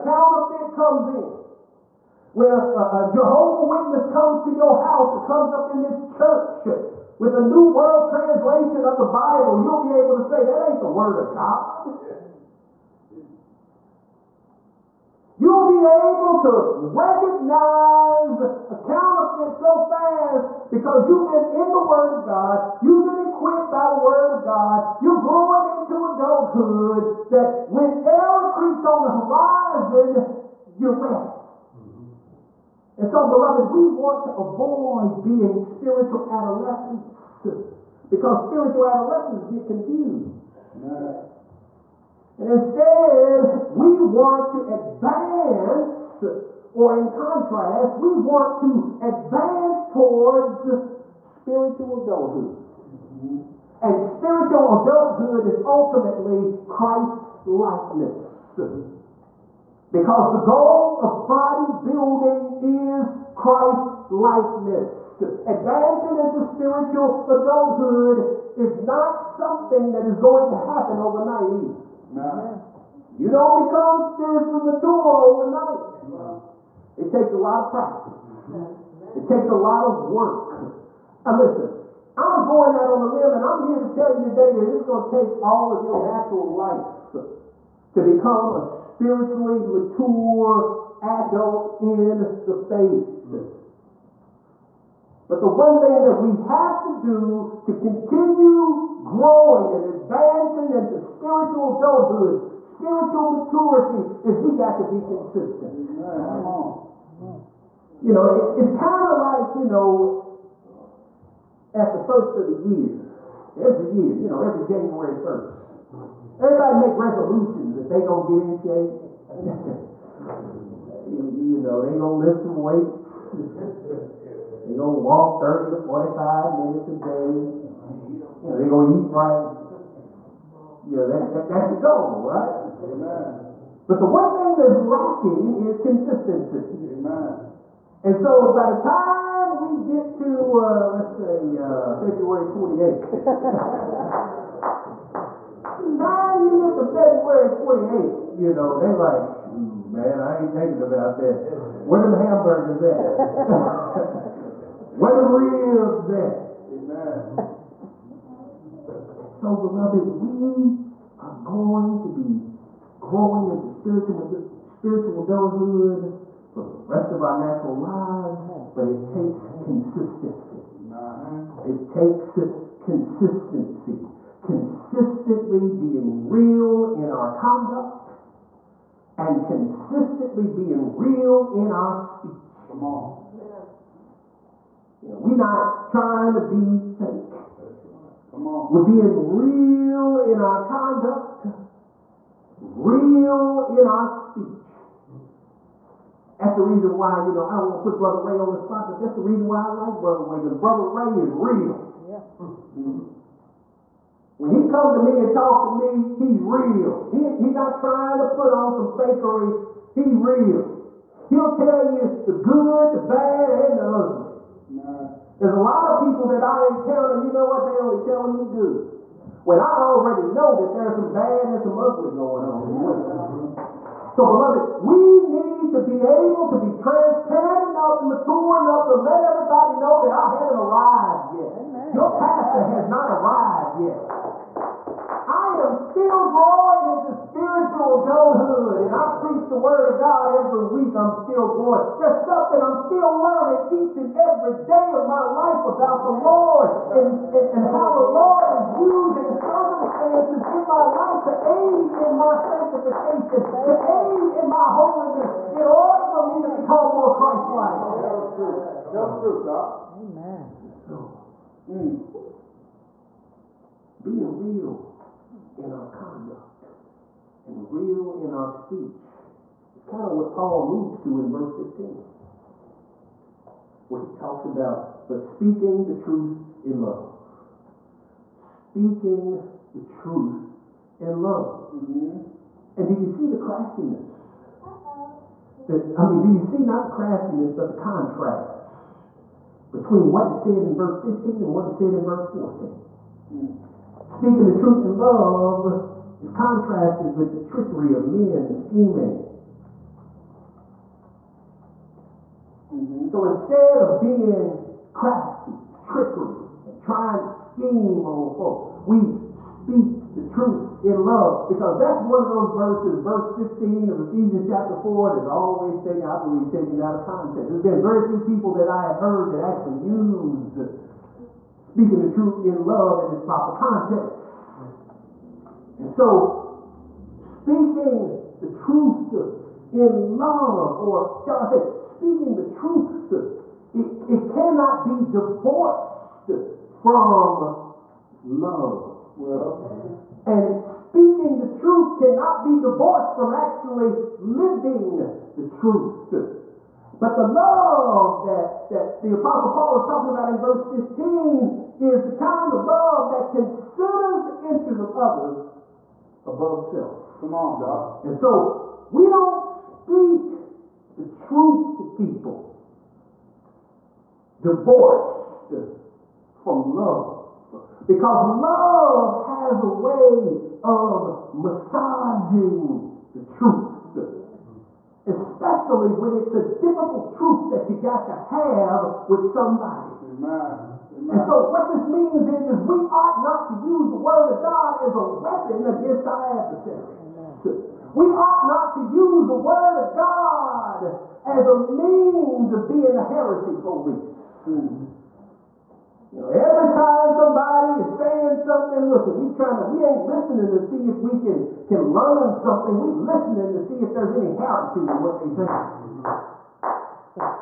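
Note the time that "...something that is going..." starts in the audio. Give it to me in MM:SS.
01:09.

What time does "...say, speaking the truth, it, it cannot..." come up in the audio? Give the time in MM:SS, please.
05:31.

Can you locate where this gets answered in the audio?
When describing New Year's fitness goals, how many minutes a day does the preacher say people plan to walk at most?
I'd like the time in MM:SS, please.
02:05.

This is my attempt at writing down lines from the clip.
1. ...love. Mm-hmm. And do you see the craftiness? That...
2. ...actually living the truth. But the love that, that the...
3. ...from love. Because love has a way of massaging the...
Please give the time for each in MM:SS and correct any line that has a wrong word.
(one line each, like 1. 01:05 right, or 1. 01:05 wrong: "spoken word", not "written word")
1. 04:41 right
2. 05:43 right
3. 06:06 right.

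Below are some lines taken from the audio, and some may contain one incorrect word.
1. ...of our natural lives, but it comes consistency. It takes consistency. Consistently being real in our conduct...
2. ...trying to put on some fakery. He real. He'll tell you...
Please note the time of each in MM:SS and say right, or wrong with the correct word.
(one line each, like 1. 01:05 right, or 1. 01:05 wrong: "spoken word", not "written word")
1. 02:47 wrong: "takes", not "comes"
2. 03:27 right.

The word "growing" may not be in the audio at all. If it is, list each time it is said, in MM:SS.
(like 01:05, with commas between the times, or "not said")
00:25, 01:39, 02:43, 03:56, 04:01.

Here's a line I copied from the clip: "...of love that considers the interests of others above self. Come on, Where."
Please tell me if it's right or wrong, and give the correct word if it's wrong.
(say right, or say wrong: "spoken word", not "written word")
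wrong: "God", not "Where".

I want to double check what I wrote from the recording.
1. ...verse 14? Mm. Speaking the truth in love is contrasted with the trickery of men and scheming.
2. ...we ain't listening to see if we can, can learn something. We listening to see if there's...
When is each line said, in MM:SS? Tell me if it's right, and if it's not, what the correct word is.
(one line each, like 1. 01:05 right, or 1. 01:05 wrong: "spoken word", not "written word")
1. 04:52 right
2. 06:39 right.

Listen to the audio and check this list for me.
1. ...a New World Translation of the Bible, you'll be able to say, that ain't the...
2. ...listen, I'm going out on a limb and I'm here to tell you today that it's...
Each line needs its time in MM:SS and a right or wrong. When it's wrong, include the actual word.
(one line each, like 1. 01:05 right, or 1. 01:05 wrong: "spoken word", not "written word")
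1. 00:07 right
2. 01:21 right.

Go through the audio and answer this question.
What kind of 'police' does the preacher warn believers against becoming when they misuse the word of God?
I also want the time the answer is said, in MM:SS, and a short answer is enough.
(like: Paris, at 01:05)
heresy police, at 06:33.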